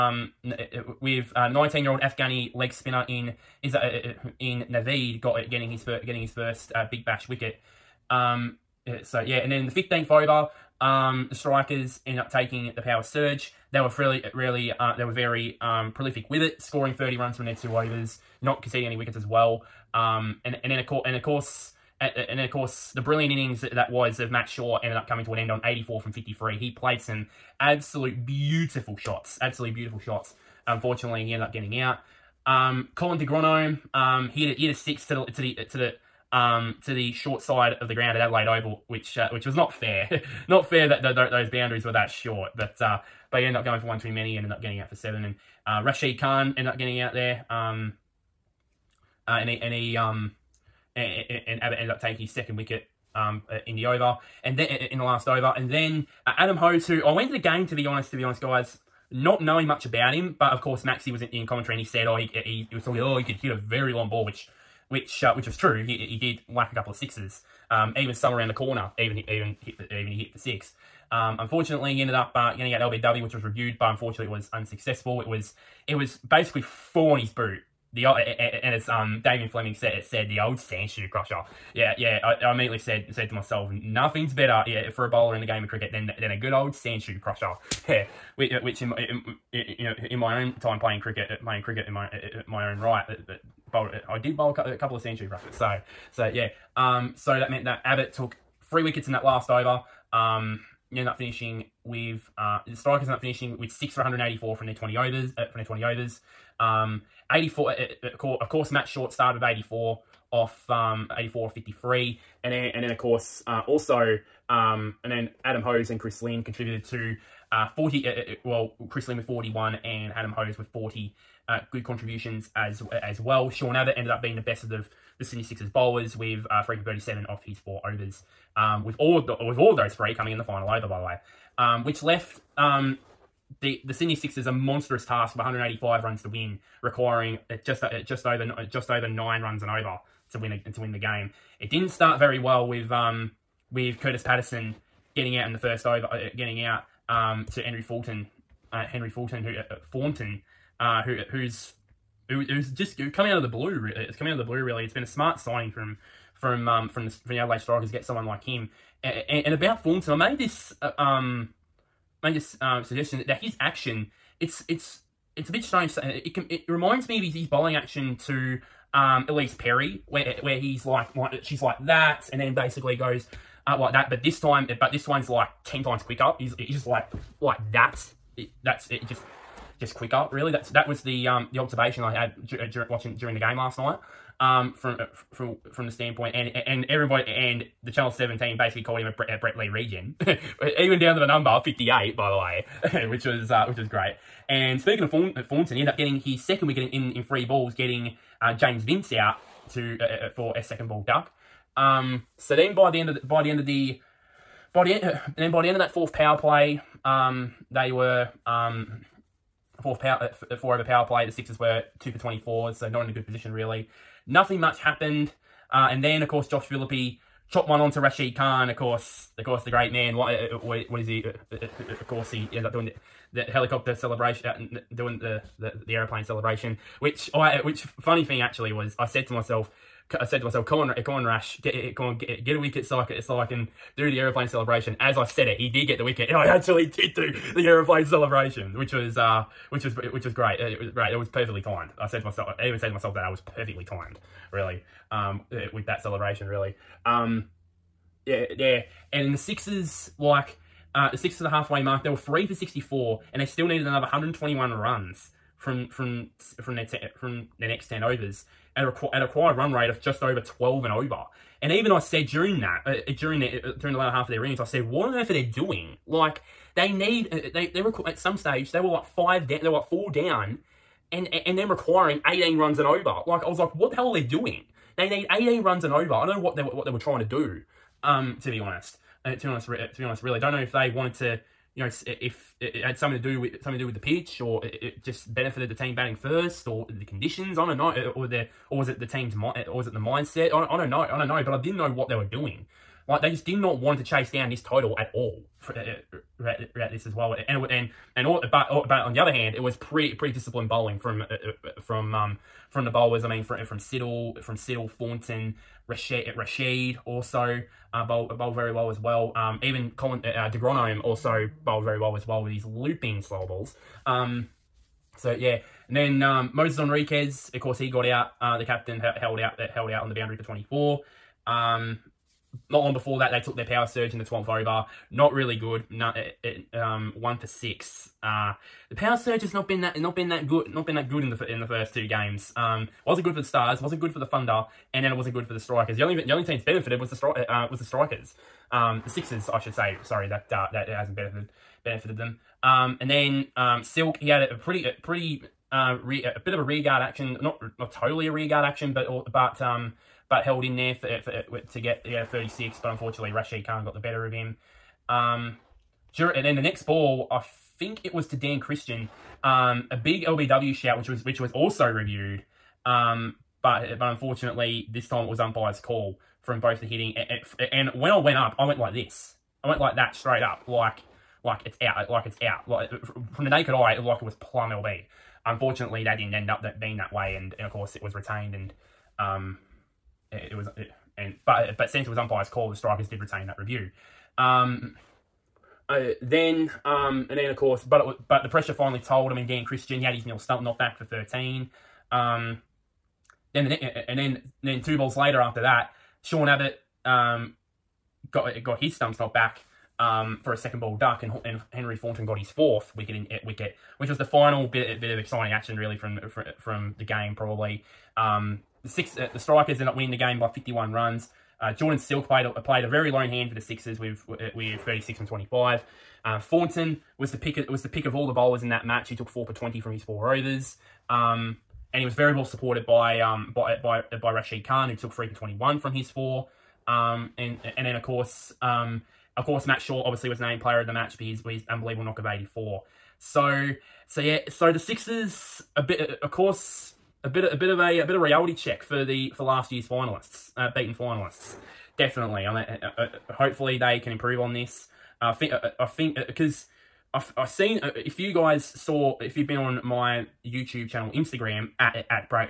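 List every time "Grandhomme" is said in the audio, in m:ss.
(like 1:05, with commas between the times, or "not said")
0:33, 5:10.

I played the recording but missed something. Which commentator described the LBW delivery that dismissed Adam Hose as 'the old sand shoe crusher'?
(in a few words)
David Fleming.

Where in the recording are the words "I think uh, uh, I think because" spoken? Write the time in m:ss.
7:25.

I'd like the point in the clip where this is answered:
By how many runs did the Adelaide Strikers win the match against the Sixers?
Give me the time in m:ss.
6:50.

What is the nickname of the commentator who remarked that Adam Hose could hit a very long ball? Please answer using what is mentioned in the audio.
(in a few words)
Maxi.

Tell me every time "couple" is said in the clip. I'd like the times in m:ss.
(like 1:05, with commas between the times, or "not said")
1:06, 1:34.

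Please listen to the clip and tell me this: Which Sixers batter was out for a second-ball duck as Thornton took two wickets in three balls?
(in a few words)
James Vince.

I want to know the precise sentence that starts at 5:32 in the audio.
Um, wasn't good for the Stars.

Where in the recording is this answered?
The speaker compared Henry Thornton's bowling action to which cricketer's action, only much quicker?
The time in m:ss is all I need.
2:49.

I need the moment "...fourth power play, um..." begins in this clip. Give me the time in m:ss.
3:25.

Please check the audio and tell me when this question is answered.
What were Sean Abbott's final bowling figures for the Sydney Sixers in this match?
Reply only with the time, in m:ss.
2:06.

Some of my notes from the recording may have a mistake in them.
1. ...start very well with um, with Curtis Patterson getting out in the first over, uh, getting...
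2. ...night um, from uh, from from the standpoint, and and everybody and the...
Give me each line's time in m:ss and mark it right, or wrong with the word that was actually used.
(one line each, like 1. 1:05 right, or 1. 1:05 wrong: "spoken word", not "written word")
1. 2:21 right
2. 3:03 right.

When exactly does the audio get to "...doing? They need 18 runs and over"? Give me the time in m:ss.
4:34.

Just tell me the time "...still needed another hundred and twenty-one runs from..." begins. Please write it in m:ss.
4:13.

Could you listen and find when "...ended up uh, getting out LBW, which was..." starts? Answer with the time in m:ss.
1:12.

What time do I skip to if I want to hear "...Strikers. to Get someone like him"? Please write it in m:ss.
2:37.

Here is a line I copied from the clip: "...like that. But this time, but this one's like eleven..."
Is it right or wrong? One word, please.
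wrong.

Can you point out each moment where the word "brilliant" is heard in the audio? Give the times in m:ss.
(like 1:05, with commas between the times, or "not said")
0:22.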